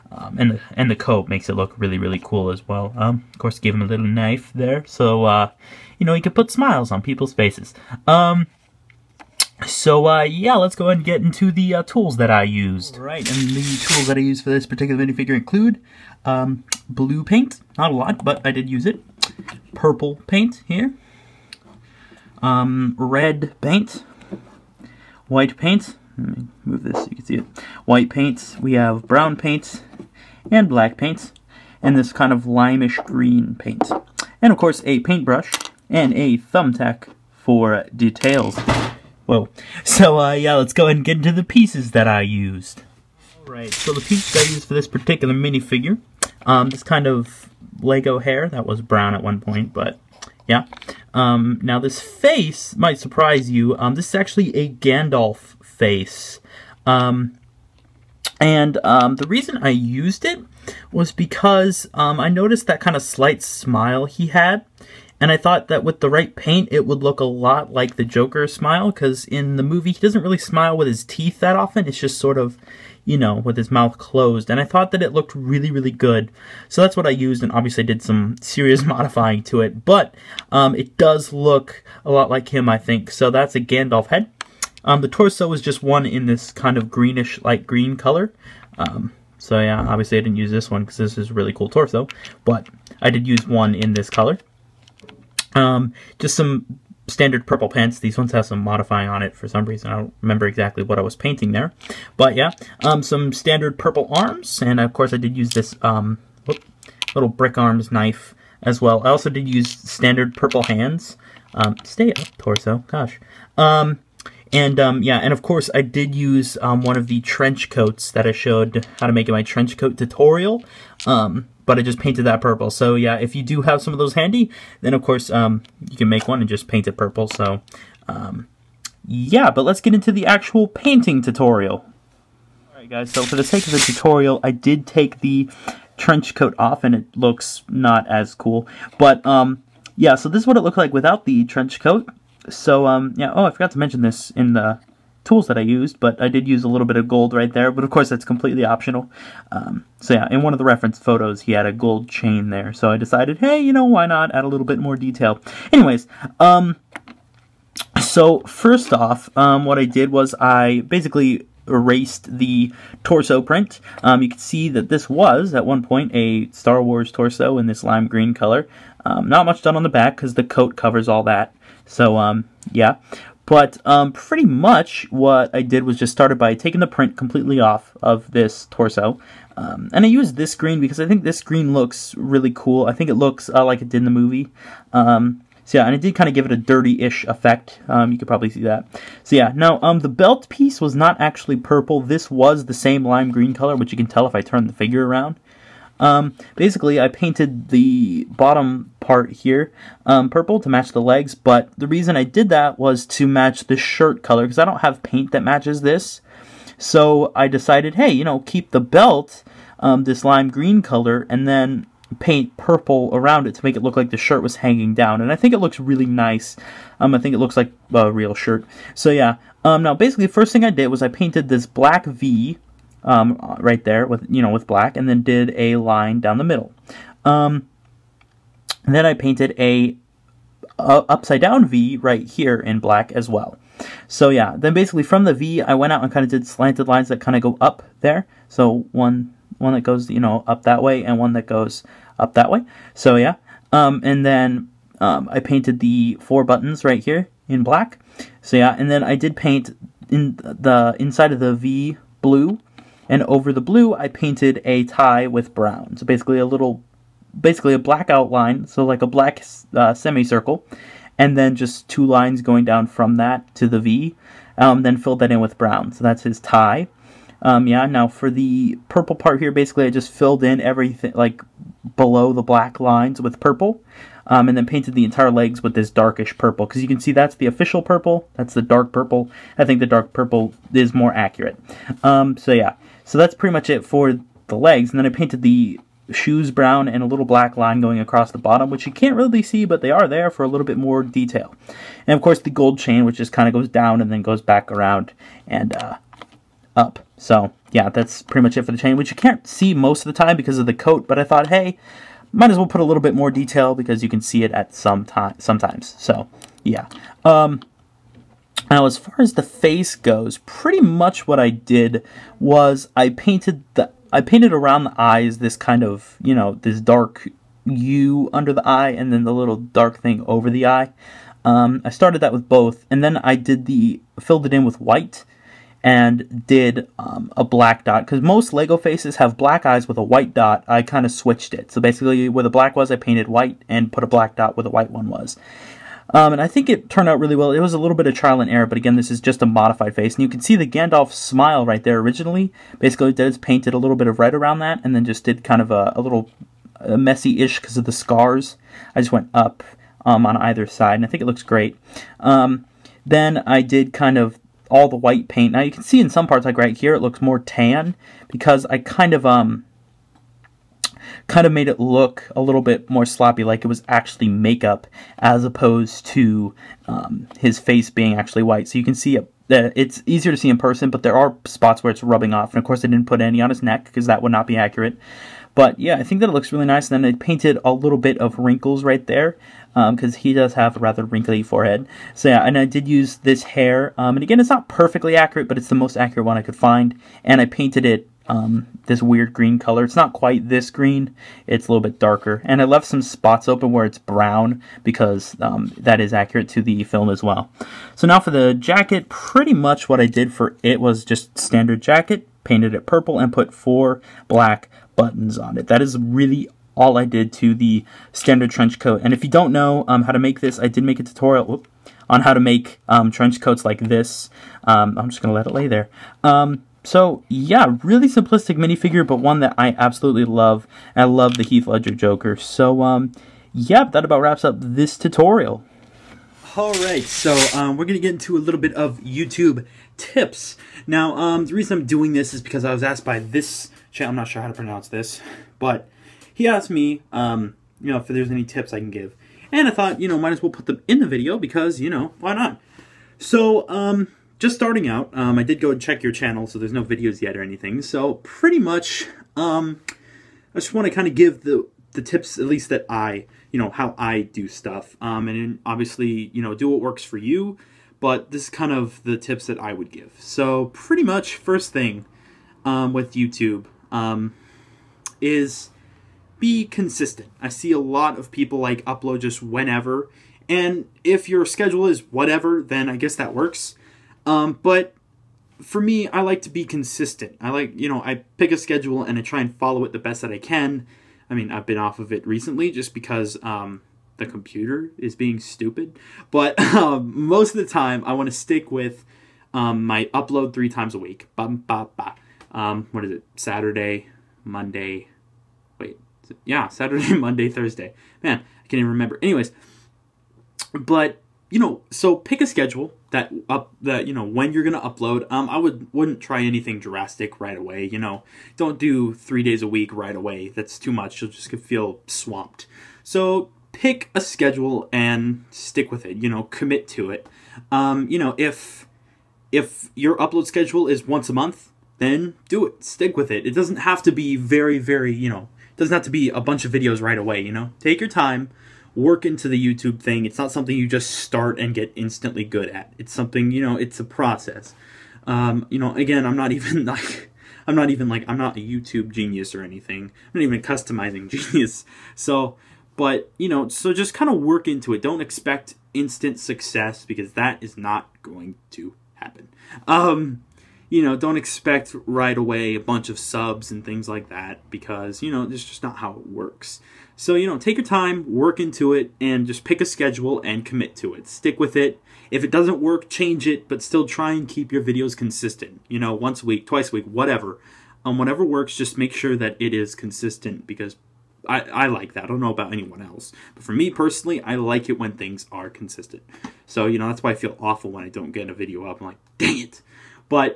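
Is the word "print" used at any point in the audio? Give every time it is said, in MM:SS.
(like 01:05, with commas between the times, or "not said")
02:43, 02:56.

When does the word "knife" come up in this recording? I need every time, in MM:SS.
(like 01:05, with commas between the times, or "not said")
00:04, 01:47.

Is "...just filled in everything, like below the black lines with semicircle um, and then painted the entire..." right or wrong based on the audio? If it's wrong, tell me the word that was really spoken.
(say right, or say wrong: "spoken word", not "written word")
wrong: "purple", not "semicircle".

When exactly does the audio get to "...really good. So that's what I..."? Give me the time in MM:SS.
01:15.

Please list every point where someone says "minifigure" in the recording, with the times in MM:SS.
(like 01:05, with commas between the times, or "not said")
00:15, 00:45, 06:58.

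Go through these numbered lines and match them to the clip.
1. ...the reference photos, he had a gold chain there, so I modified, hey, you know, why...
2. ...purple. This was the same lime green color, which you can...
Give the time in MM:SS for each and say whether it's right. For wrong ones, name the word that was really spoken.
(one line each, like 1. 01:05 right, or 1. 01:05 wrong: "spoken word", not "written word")
1. 02:30 wrong: "decided", not "modified"
2. 03:11 right.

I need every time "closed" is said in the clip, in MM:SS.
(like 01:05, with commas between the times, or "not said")
01:13.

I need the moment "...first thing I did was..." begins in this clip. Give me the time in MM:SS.
03:40.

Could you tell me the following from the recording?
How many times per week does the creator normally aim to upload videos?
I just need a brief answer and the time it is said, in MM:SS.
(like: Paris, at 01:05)
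3, at 08:10.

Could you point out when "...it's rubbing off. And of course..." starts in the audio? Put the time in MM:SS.
06:11.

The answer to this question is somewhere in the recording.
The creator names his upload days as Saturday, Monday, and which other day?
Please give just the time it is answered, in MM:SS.
08:17.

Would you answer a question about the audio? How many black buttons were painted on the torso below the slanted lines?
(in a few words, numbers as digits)
4.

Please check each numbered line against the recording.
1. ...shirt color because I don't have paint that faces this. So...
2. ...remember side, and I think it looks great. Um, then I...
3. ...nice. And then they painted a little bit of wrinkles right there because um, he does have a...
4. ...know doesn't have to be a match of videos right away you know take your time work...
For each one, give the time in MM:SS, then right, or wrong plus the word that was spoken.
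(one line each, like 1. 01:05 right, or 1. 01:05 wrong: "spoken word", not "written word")
1. 03:23 wrong: "matches", not "faces"
2. 05:50 wrong: "either", not "remember"
3. 06:16 right
4. 08:45 wrong: "bunch", not "match".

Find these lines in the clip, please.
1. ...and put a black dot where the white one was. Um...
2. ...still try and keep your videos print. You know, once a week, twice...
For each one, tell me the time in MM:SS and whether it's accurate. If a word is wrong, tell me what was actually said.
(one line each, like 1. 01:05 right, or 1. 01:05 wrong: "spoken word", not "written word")
1. 05:33 right
2. 09:23 wrong: "consistent", not "print".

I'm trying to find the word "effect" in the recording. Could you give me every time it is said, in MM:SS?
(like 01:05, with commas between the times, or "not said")
03:07.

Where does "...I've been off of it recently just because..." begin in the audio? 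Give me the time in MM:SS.
08:01.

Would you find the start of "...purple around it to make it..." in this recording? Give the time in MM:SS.
03:32.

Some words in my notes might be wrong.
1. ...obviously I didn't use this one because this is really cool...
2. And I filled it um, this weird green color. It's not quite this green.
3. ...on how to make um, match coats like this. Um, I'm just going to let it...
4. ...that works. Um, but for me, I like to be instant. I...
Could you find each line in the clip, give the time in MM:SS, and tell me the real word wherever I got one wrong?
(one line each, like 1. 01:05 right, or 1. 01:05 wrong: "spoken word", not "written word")
1. 01:29 right
2. 06:27 wrong: "painted", not "filled"
3. 06:52 wrong: "trench", not "match"
4. 07:53 wrong: "consistent", not "instant".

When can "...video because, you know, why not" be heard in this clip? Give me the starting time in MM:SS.
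07:21.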